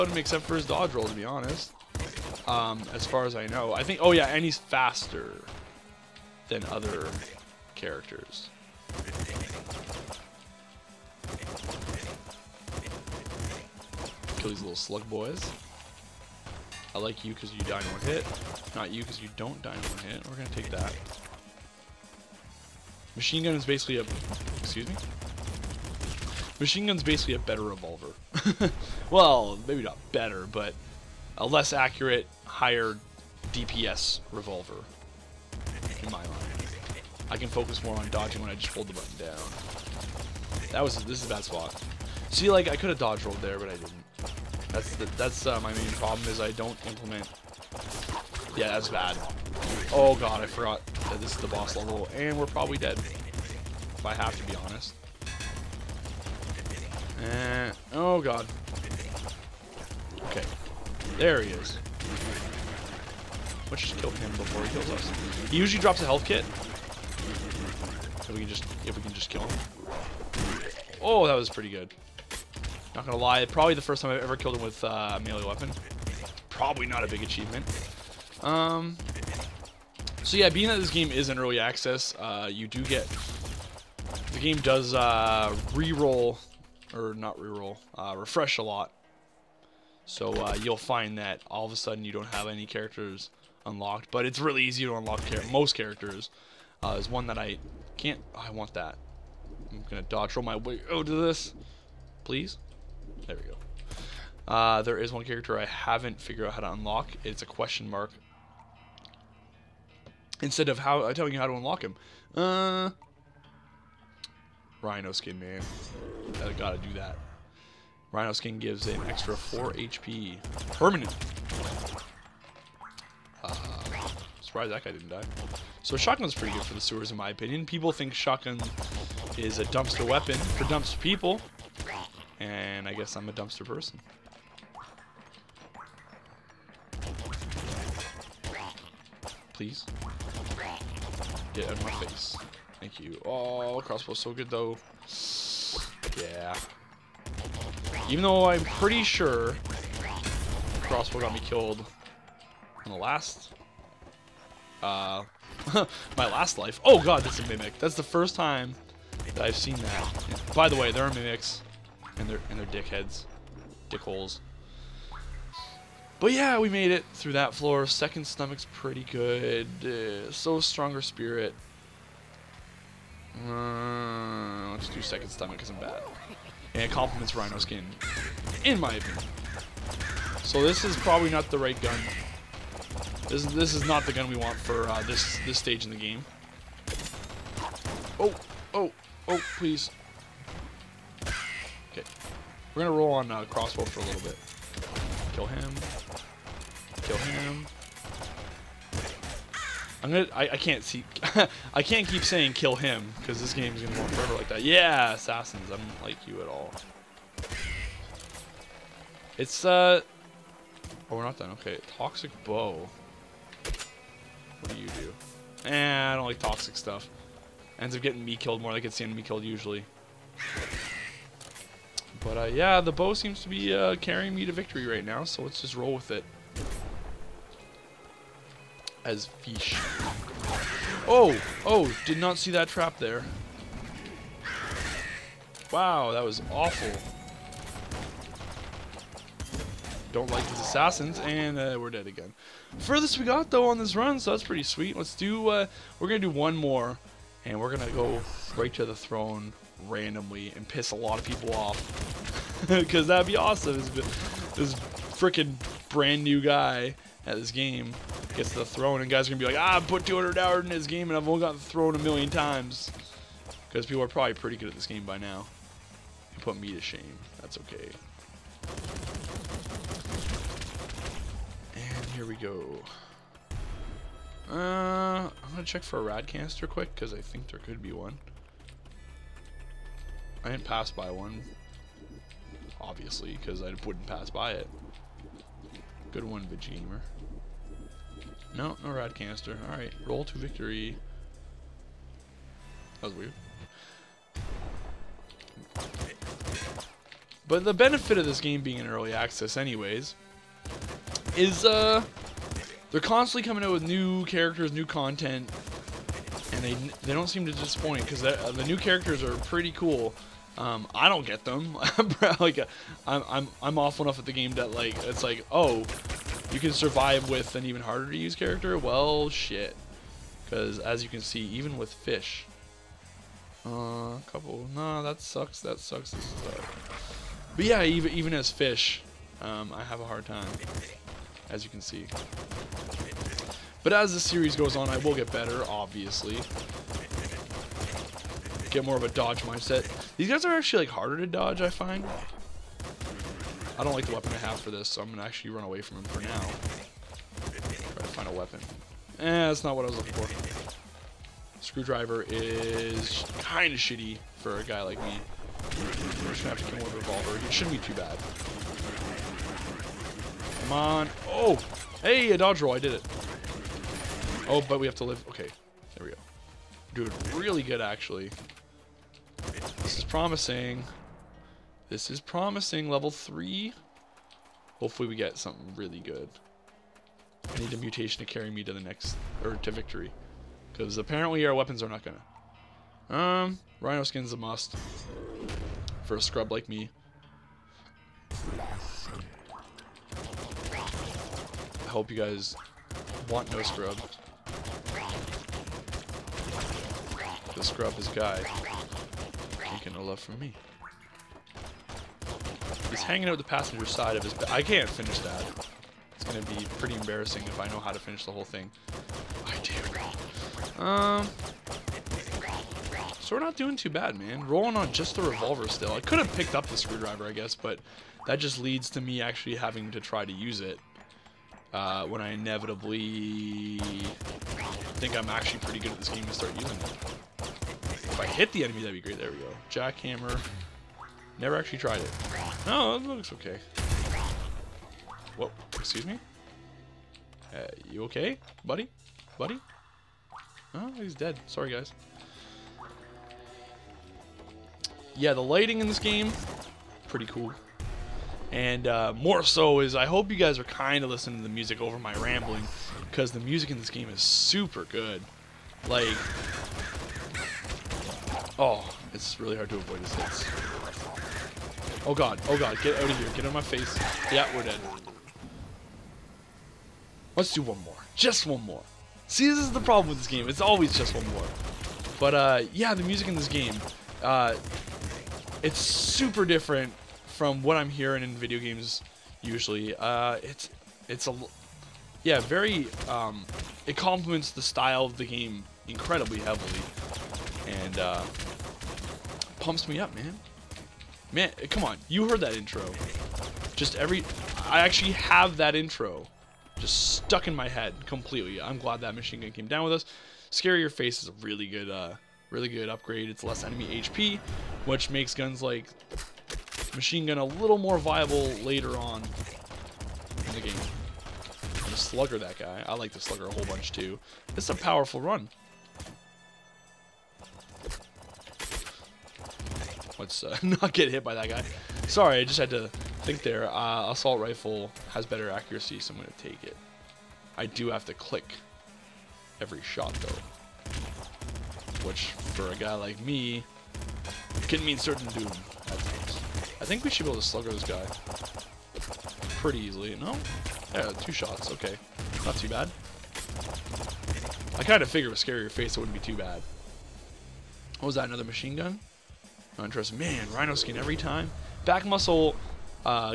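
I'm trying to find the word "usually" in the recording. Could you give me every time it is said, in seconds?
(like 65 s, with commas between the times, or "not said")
65 s, 219 s, 479 s.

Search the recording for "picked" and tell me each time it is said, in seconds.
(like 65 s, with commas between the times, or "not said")
416 s.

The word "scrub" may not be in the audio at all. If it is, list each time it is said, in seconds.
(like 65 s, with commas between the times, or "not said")
386 s, 393 s, 397 s.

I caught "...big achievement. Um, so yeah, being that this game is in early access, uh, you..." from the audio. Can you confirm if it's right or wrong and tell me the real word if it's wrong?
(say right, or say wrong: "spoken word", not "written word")
right.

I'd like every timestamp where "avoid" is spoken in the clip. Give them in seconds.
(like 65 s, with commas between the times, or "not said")
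459 s.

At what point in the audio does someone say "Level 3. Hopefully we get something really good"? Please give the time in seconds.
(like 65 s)
372 s.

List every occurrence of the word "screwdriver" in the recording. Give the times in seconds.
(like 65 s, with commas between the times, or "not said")
351 s, 416 s.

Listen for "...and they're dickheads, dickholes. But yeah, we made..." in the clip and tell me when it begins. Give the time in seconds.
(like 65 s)
162 s.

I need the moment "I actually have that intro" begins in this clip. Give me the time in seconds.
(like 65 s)
494 s.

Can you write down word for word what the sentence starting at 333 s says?
But as the series goes on, I will get better, obviously.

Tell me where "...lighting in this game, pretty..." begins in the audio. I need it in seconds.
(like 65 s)
445 s.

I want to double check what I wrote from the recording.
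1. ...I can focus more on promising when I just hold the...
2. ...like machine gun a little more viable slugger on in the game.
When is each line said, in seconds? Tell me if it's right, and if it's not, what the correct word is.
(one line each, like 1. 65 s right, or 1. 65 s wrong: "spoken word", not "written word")
1. 37 s wrong: "dodging", not "promising"
2. 505 s wrong: "later", not "slugger".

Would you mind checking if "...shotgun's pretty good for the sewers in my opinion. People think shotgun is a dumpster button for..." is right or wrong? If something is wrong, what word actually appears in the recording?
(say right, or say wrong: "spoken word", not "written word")
wrong: "weapon", not "button".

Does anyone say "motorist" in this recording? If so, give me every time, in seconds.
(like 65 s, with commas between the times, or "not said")
not said.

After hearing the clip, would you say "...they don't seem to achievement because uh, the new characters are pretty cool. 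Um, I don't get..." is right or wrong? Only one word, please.
wrong.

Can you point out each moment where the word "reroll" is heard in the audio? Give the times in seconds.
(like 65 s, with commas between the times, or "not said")
87 s.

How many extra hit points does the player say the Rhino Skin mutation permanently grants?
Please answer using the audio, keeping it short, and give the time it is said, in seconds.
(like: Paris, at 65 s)
4, at 119 s.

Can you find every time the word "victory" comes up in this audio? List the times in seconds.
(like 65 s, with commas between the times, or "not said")
224 s, 290 s, 379 s.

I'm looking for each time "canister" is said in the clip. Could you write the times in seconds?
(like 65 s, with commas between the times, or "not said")
276 s, 289 s.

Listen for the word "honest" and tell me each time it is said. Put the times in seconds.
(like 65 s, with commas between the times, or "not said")
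1 s, 54 s.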